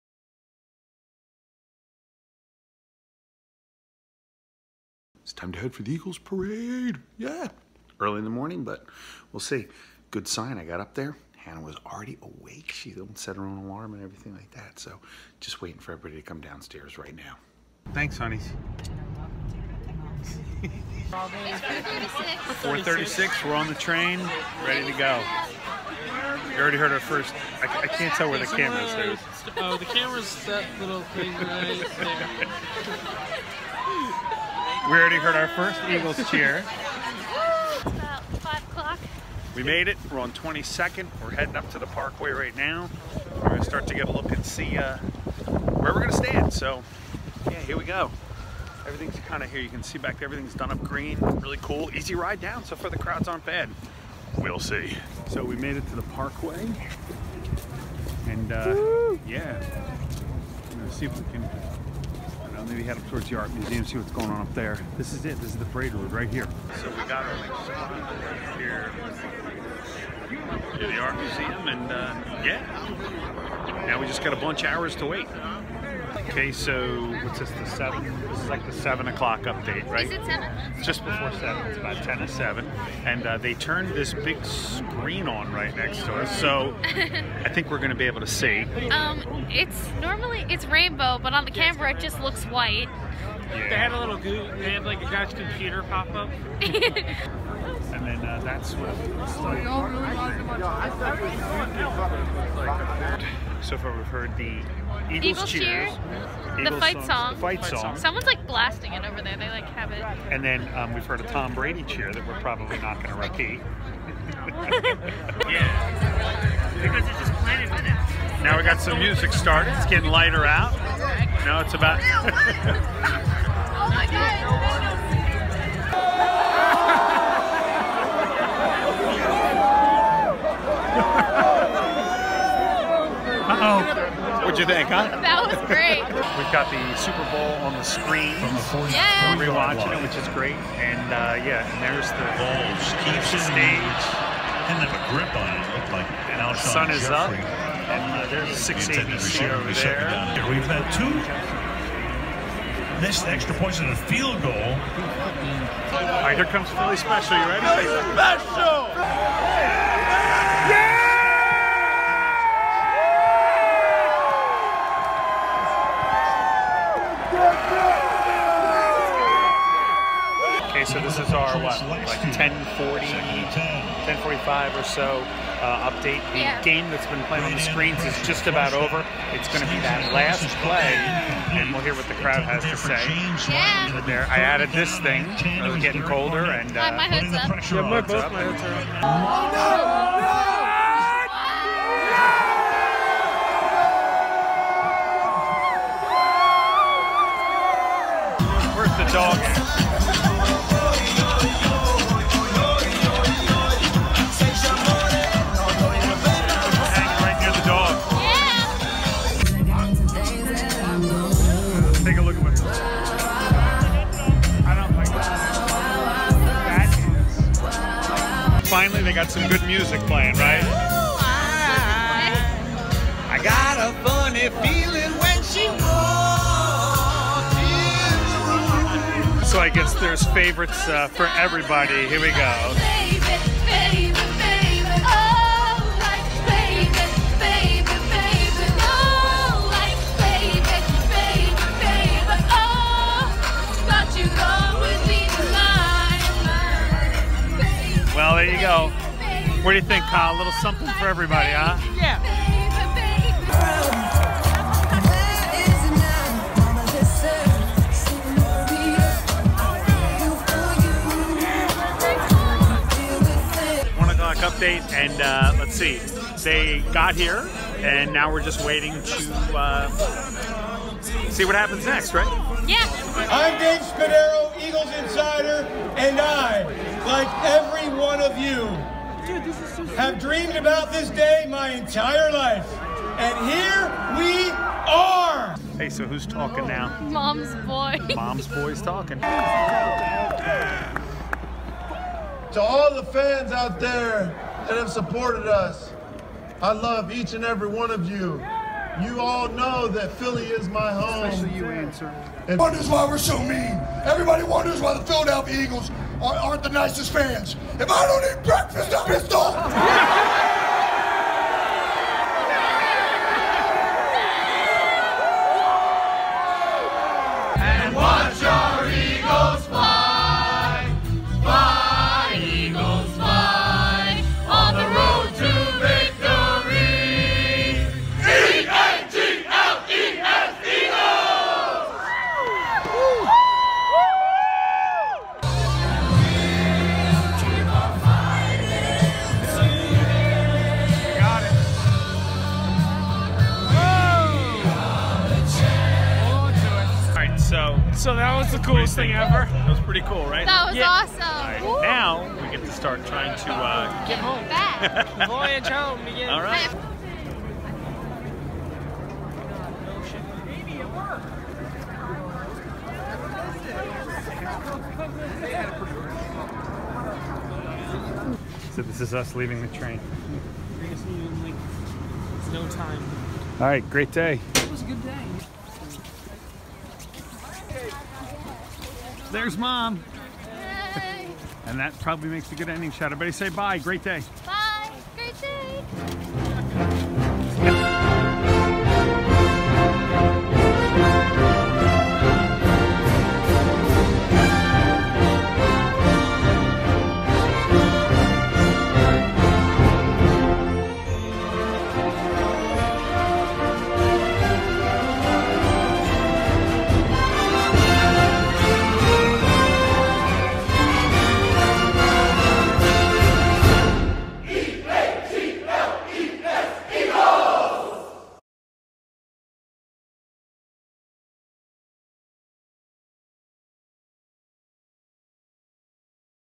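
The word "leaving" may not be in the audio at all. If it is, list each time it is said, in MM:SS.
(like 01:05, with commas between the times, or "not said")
06:09.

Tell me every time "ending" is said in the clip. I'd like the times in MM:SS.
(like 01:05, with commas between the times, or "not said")
06:22.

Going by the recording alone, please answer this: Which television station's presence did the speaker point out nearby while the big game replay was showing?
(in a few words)
6 ABC.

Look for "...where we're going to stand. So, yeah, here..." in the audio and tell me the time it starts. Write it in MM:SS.
00:45.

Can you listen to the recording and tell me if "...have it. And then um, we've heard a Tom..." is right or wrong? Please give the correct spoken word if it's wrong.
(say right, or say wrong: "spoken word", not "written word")
right.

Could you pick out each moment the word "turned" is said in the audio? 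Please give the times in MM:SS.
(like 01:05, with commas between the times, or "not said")
01:23.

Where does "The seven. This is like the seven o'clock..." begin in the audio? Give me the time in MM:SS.
01:17.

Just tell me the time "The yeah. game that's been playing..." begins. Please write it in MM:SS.
02:56.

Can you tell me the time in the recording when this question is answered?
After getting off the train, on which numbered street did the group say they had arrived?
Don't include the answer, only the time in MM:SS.
00:40.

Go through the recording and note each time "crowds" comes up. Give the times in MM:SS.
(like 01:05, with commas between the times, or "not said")
00:52, 03:02.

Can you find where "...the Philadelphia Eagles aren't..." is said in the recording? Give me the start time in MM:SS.
05:04.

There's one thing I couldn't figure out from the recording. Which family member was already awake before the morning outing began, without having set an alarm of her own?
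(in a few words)
Hannah.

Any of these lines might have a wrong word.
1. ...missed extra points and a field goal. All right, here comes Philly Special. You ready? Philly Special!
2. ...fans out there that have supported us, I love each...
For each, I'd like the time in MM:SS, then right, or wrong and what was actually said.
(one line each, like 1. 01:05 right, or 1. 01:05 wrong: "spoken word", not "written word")
1. 02:33 right
2. 04:53 right.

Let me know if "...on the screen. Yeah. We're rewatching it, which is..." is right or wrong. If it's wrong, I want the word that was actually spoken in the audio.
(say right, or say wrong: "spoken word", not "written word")
right.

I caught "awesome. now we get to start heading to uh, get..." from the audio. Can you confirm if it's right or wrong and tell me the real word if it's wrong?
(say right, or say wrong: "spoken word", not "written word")
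wrong: "trying", not "heading".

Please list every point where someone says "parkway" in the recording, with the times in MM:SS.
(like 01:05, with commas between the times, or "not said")
00:41, 00:56.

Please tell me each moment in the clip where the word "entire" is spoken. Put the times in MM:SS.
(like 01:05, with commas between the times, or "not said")
04:41.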